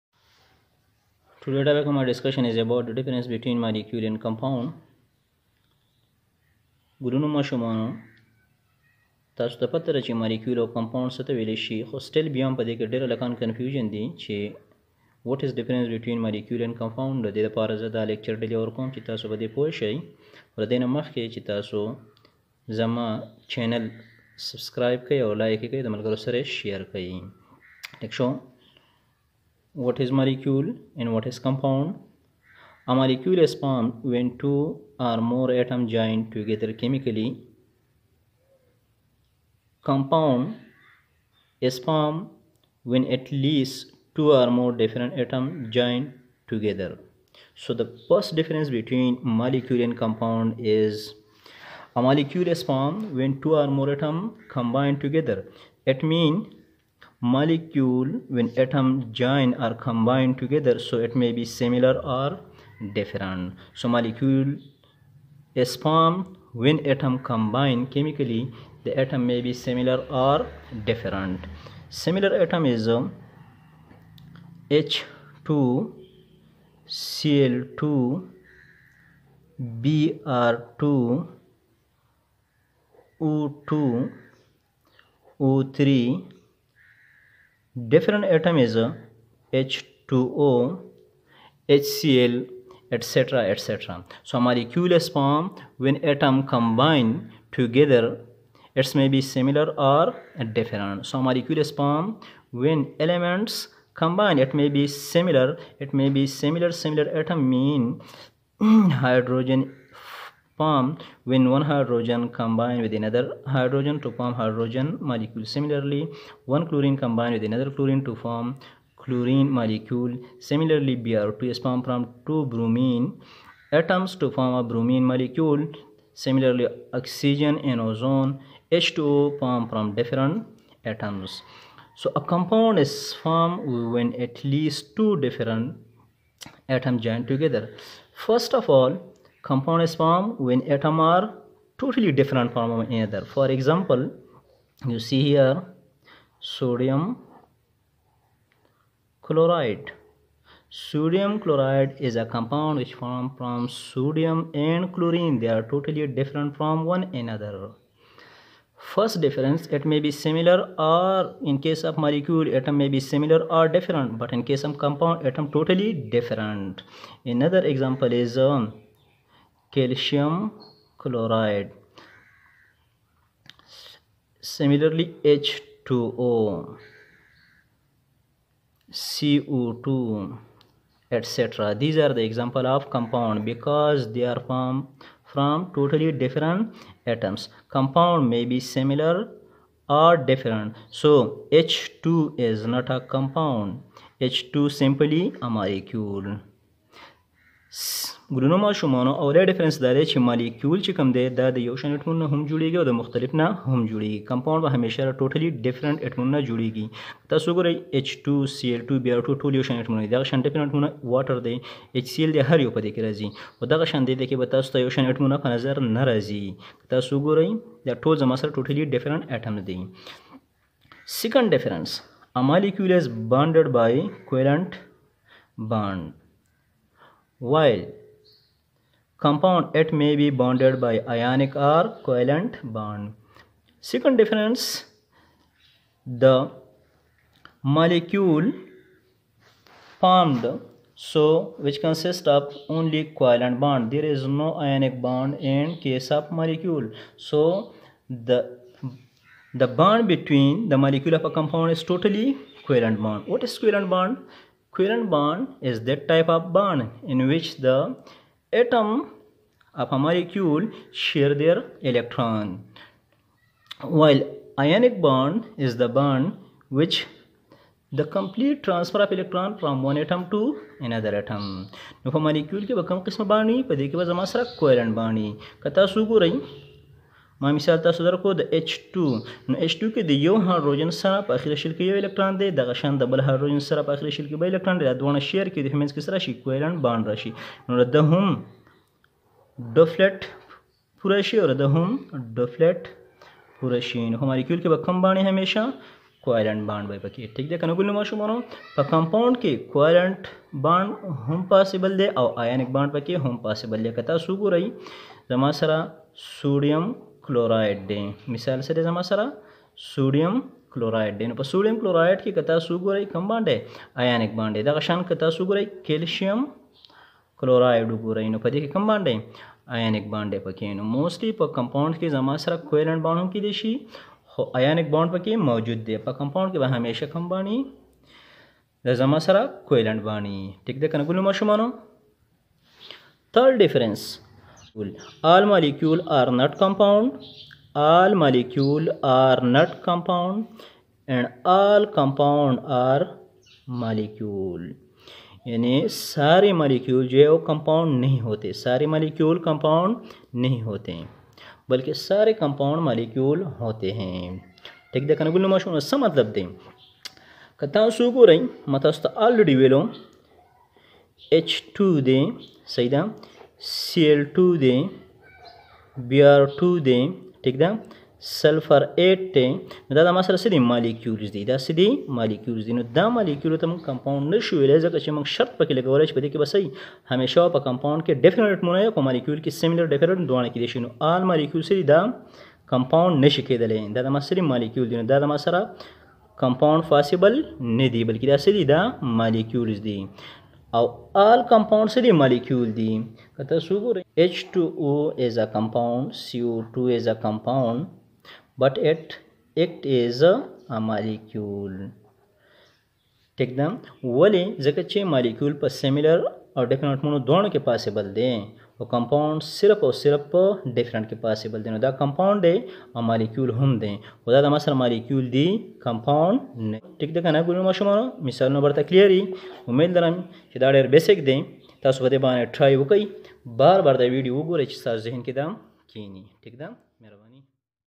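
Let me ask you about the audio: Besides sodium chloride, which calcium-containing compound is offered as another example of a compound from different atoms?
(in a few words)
calcium chloride.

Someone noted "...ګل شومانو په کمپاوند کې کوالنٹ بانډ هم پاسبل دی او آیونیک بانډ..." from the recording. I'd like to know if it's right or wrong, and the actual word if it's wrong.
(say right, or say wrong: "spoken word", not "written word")
wrong: "ماشومانو", not "شومانو".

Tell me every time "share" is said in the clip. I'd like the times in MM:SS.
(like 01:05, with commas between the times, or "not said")
04:20.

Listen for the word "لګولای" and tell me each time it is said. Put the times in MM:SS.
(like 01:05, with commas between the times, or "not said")
06:15.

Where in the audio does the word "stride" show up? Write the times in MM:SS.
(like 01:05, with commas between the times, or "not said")
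not said.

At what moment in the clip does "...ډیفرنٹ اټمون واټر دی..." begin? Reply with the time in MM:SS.
03:30.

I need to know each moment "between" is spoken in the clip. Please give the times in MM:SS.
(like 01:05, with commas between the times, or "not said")
00:03, 00:48, 04:10.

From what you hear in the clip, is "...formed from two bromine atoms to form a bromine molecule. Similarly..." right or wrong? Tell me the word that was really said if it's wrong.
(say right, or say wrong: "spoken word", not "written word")
right.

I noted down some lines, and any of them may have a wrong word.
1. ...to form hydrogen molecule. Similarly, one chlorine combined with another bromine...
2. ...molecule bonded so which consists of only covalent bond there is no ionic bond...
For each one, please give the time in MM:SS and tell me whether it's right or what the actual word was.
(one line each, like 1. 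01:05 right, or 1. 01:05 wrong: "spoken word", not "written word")
1. 01:54 wrong: "chlorine", not "bromine"
2. 03:57 wrong: "formed", not "bonded".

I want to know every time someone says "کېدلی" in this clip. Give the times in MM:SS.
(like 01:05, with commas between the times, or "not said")
06:23.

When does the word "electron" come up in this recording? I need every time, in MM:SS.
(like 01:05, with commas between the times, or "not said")
04:21, 04:29.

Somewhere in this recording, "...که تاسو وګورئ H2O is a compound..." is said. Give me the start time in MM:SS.
06:33.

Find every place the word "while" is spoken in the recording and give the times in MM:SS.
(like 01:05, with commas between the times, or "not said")
03:47, 04:23.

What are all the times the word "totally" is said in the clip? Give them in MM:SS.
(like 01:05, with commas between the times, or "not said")
02:21, 02:35, 02:45, 03:05, 04:11.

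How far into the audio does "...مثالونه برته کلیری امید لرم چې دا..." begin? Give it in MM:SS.
06:58.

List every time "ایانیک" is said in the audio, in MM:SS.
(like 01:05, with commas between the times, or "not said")
05:14, 05:19, 05:24.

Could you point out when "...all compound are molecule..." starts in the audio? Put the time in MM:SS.
05:41.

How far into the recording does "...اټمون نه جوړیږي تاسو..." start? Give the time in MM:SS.
03:26.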